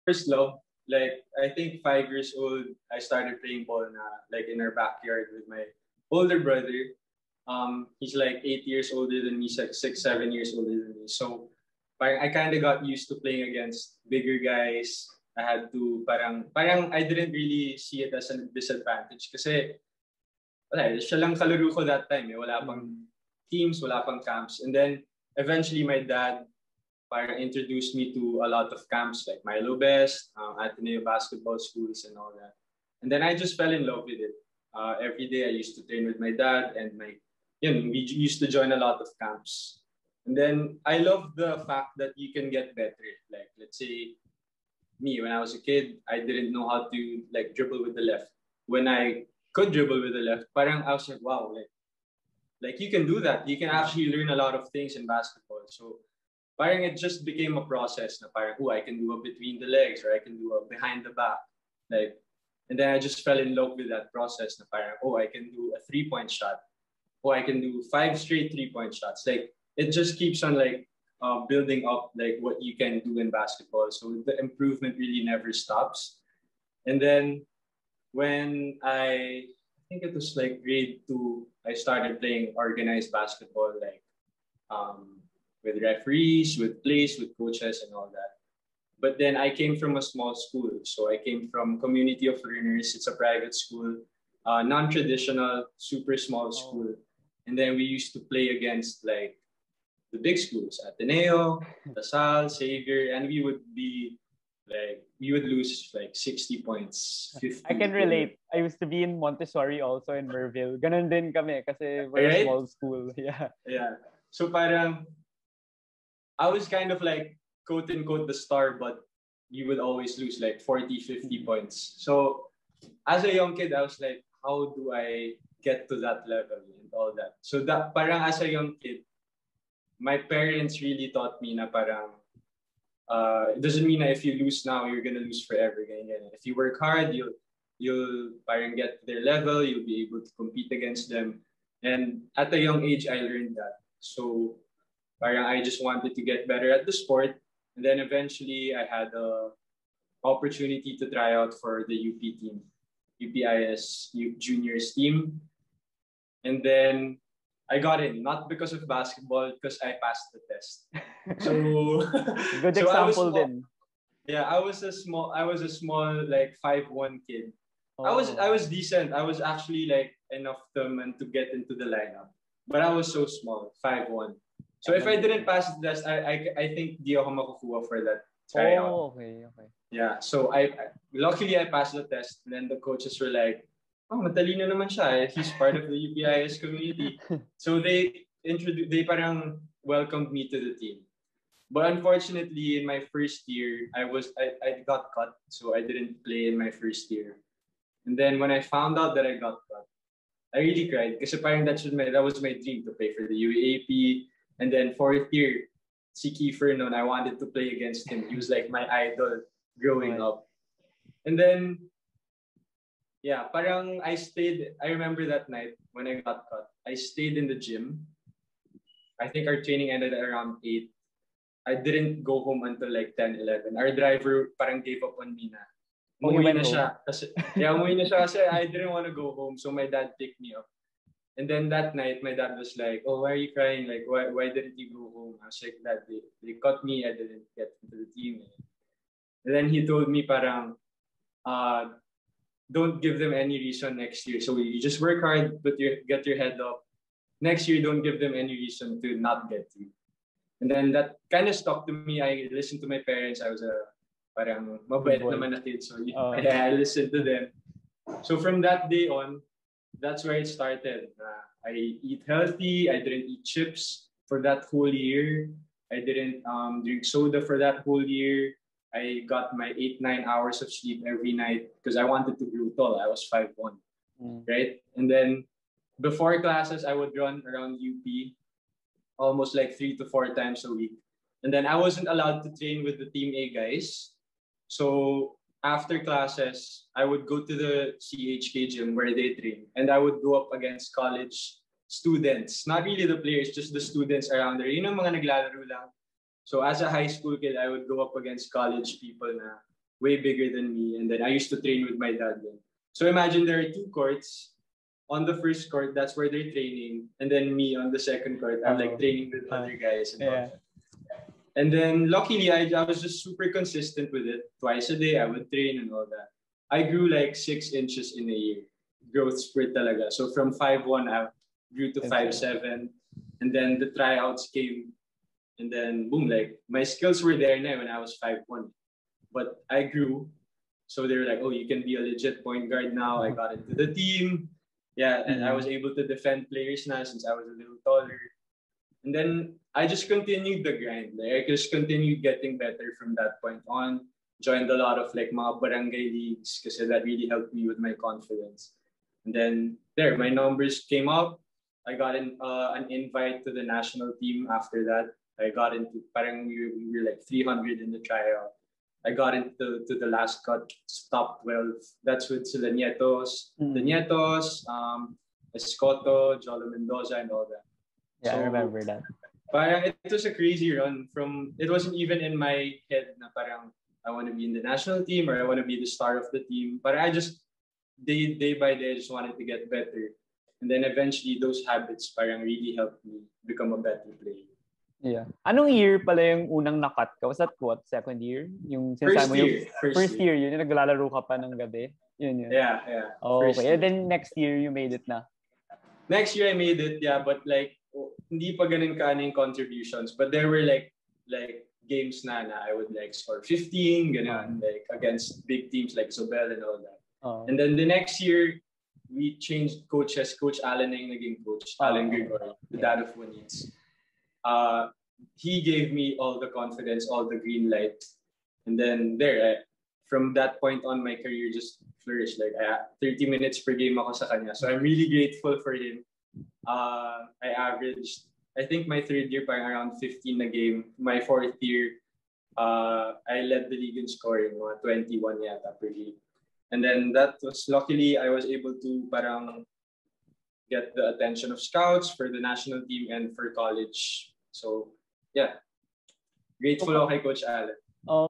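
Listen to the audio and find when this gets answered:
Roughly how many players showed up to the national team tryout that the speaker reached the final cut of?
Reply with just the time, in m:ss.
5:57.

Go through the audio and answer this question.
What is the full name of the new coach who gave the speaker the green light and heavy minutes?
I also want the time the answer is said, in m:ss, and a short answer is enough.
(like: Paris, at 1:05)
Allen Gregory, at 6:51.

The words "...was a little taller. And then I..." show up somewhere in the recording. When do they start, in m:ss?
5:37.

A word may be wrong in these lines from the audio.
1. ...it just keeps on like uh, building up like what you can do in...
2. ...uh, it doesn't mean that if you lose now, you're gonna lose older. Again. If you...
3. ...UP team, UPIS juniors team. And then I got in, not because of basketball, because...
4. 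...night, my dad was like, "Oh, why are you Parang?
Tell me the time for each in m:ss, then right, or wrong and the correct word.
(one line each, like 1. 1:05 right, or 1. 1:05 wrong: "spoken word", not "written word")
1. 1:09 right
2. 2:13 wrong: "forever", not "older"
3. 2:31 right
4. 3:51 wrong: "crying", not "Parang".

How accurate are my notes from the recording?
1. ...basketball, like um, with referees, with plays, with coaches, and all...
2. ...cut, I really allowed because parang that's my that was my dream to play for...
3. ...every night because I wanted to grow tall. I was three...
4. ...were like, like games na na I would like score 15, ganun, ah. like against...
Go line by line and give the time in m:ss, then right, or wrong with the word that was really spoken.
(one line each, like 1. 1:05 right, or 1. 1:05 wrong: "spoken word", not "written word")
1. 1:23 right
2. 3:19 wrong: "cried", not "allowed"
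3. 4:31 wrong: "five", not "three"
4. 6:40 right.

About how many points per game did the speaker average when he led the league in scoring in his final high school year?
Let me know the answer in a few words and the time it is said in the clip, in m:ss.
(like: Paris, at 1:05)
21, at 7:14.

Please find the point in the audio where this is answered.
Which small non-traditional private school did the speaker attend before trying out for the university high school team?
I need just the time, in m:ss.
1:31.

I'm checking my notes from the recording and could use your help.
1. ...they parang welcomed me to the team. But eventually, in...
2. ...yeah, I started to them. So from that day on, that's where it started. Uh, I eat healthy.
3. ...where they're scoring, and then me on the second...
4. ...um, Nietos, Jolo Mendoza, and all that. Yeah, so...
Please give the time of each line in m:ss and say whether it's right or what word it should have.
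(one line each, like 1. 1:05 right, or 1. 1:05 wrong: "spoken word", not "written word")
1. 3:08 wrong: "unfortunately", not "eventually"
2. 4:16 wrong: "listened", not "started"
3. 5:06 wrong: "training", not "scoring"
4. 6:04 wrong: "Escoto", not "Nietos".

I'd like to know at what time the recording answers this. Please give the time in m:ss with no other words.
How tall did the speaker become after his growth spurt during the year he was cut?
5:22.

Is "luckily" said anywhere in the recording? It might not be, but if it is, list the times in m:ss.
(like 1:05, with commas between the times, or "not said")
3:01, 5:12, 7:17.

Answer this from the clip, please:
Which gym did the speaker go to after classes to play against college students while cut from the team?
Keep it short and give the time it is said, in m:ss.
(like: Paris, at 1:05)
CHK gym, at 4:48.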